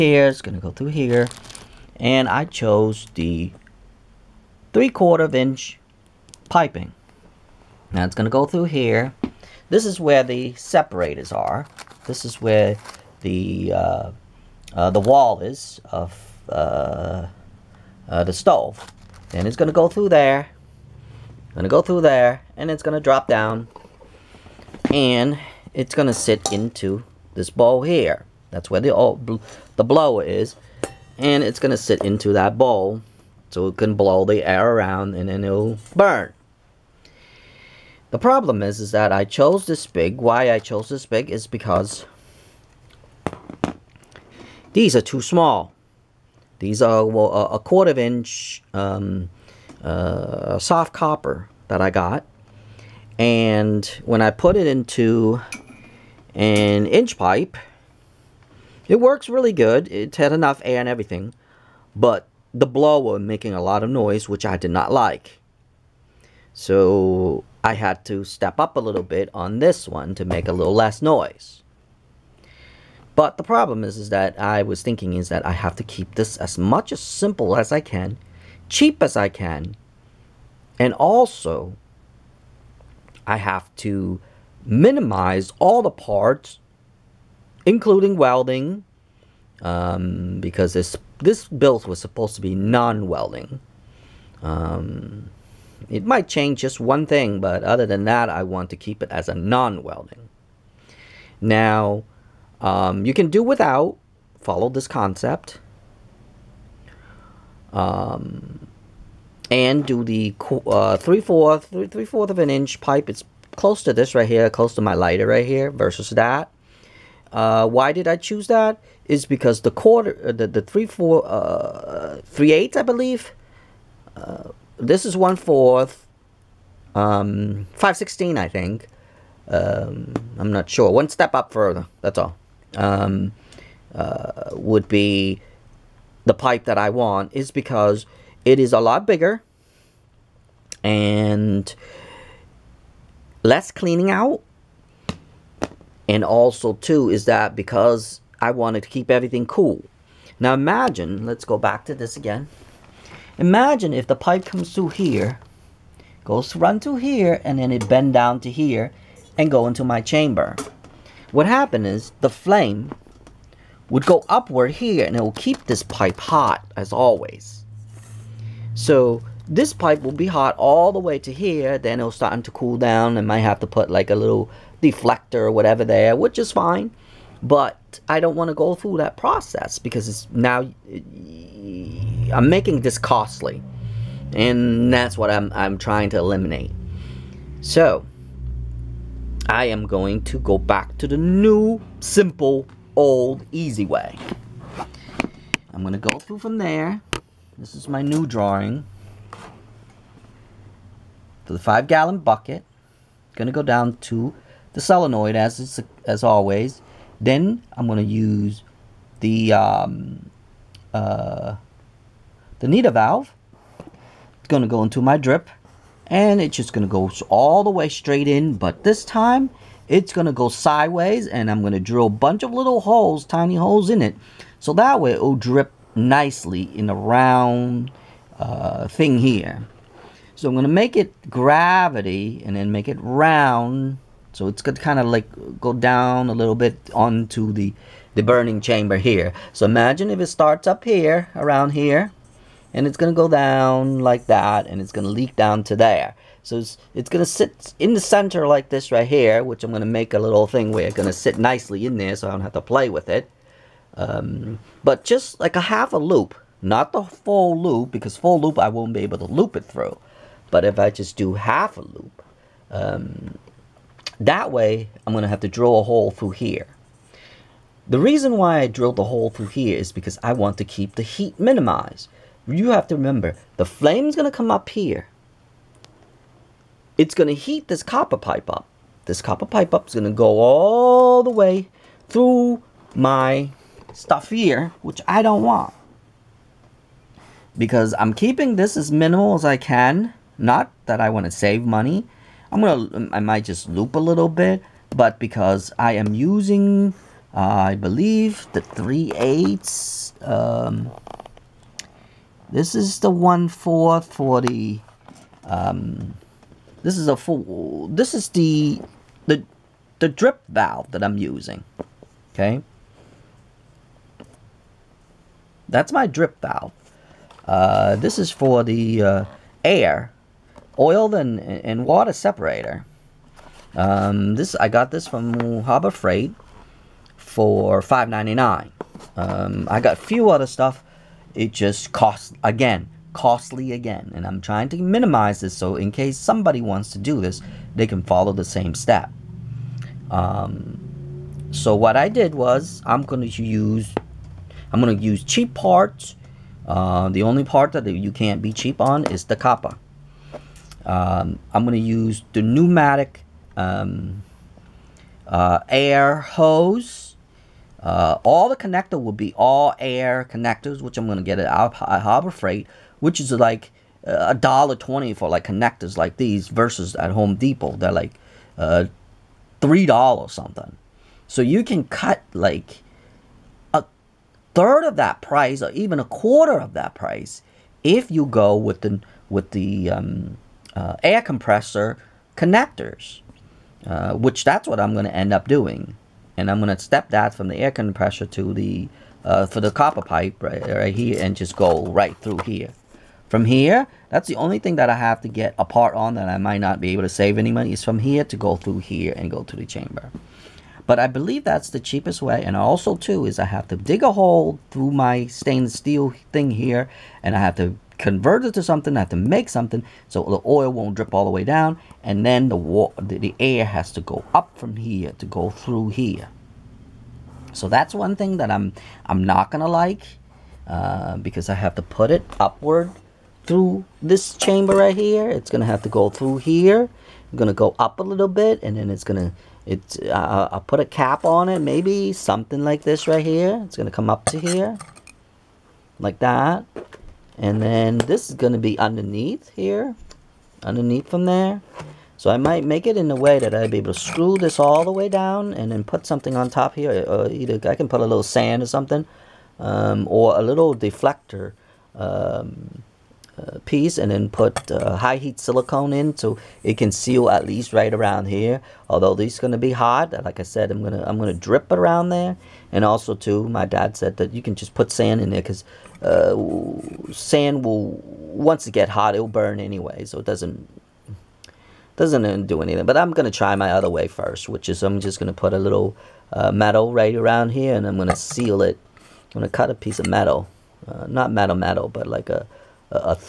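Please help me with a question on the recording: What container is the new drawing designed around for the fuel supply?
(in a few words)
Five gallon bucket.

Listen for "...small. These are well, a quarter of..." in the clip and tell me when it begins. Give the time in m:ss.
0:45.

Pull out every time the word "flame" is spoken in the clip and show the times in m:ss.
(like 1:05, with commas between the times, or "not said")
2:42, 4:33.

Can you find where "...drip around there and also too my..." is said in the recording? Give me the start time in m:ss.
7:41.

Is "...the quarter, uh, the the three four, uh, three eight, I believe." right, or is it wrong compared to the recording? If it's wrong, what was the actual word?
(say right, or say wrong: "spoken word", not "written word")
right.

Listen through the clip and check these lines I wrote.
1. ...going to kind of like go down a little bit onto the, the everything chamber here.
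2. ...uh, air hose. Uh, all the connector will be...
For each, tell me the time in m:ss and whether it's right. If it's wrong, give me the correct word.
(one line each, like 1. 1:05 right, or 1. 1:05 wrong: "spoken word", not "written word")
1. 3:54 wrong: "burning", not "everything"
2. 5:55 right.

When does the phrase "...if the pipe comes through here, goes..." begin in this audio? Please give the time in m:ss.
2:33.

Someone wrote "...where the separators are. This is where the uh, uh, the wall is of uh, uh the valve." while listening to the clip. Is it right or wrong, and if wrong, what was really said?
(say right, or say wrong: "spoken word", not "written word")
wrong: "stove", not "valve".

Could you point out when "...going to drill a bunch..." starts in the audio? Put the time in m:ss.
3:41.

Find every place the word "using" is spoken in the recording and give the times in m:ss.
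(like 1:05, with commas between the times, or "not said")
4:56, 5:11.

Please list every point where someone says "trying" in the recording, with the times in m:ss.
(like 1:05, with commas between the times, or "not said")
3:05, 5:34.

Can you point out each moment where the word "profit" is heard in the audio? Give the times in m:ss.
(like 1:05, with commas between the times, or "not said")
not said.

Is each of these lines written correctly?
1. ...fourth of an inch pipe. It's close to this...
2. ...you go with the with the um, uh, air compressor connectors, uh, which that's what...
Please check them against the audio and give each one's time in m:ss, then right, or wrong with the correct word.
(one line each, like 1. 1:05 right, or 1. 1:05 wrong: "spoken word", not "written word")
1. 1:52 right
2. 6:18 right.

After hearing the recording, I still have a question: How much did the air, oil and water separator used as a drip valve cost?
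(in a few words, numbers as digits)
$5.99.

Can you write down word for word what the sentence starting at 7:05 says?
It's gonna have to go through here.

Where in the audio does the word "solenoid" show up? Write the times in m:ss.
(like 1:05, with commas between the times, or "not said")
3:24.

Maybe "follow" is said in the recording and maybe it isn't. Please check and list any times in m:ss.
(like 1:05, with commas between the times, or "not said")
1:44, 5:38.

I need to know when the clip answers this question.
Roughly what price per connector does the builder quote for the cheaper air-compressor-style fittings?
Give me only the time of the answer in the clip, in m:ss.
6:04.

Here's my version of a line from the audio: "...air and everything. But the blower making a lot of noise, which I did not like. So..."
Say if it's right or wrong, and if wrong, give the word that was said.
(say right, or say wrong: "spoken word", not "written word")
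right.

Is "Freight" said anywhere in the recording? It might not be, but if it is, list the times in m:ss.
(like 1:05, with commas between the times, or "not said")
5:25, 6:02.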